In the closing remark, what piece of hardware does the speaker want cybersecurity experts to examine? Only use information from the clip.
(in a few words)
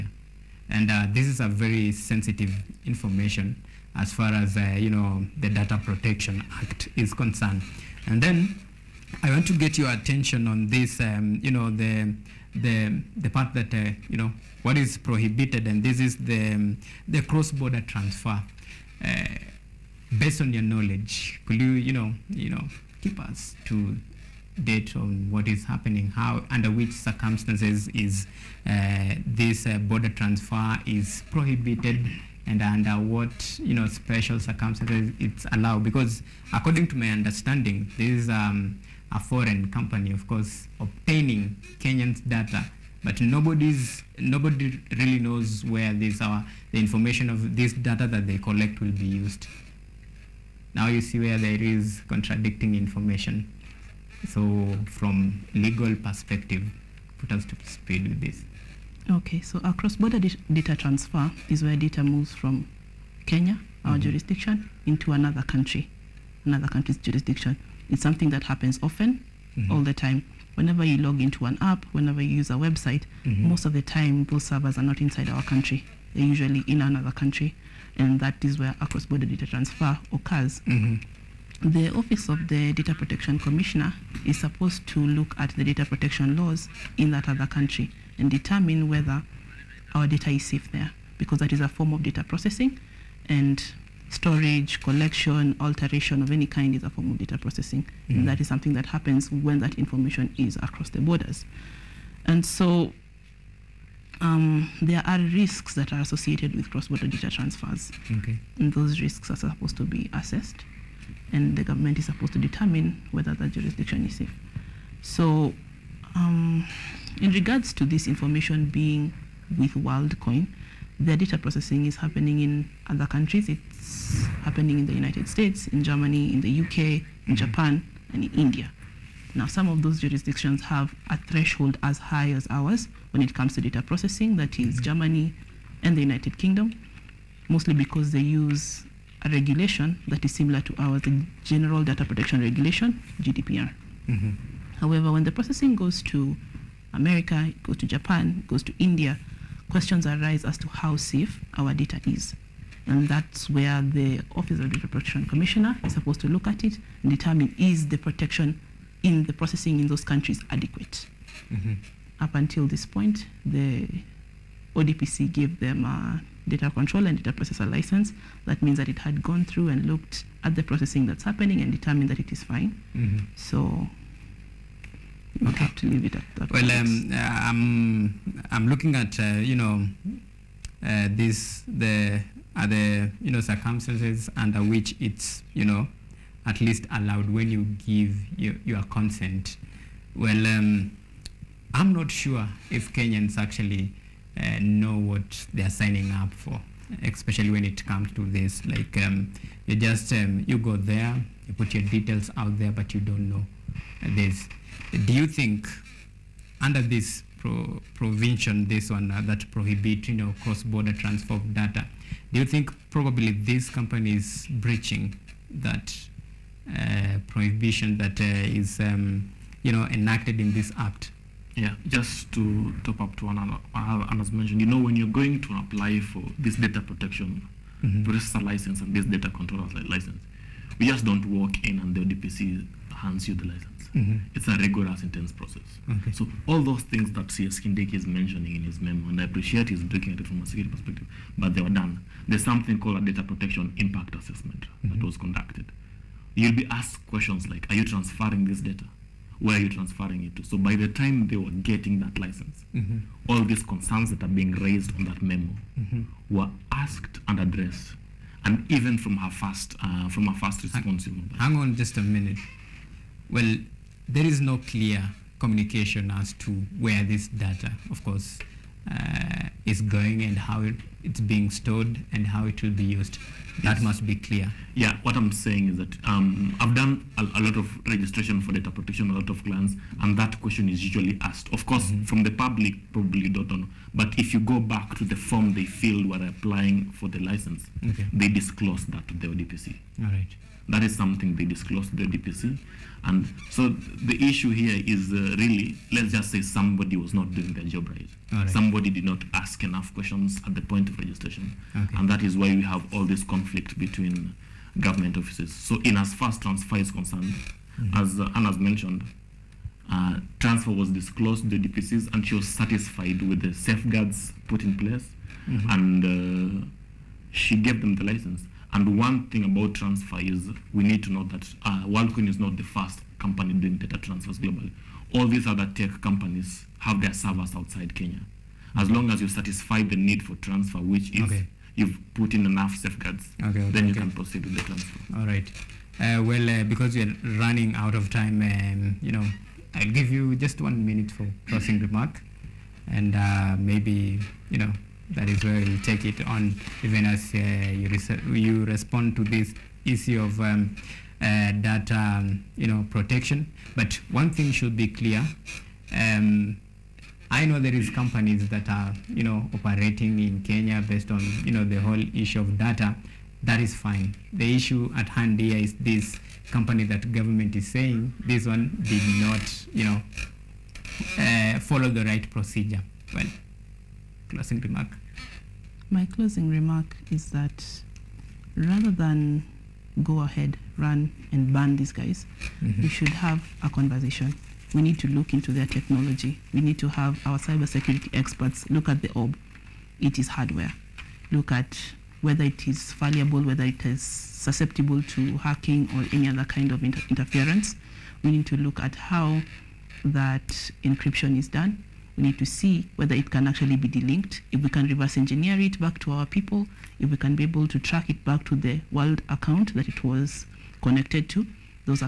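The orb.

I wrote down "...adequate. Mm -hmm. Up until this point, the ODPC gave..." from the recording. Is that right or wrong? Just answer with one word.
right.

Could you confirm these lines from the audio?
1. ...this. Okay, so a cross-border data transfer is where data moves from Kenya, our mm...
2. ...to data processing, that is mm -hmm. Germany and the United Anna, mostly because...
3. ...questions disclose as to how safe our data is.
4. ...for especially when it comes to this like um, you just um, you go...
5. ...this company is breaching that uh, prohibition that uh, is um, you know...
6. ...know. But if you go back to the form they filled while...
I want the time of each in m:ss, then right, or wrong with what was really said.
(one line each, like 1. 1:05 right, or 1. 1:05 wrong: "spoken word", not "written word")
1. 0:58 right
2. 2:13 wrong: "Kingdom", not "Anna"
3. 2:29 wrong: "arise", not "disclose"
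4. 3:16 right
5. 3:33 right
6. 4:43 right.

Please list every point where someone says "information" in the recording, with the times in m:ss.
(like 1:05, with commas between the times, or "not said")
0:02, 0:46, 0:52, 1:39, 1:58.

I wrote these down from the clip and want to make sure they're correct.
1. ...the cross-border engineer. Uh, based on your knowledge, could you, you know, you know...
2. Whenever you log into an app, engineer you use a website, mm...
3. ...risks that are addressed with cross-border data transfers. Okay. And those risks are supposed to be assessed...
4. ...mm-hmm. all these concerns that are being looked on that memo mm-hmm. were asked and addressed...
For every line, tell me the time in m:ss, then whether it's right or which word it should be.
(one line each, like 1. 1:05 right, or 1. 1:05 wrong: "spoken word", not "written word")
1. 0:17 wrong: "transfer", not "engineer"
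2. 1:10 wrong: "whenever", not "engineer"
3. 1:45 wrong: "associated", not "addressed"
4. 4:12 wrong: "raised", not "looked".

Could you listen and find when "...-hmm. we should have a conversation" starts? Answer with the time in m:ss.
6:22.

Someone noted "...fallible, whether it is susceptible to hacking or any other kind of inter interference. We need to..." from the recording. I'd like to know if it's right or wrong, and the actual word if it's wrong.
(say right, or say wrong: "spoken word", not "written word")
right.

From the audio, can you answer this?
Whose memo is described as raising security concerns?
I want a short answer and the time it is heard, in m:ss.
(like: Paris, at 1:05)
C.S. Kindiki, at 3:57.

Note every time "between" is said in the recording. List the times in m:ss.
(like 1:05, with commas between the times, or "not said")
5:03.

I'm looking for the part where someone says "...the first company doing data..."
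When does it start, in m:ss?
5:22.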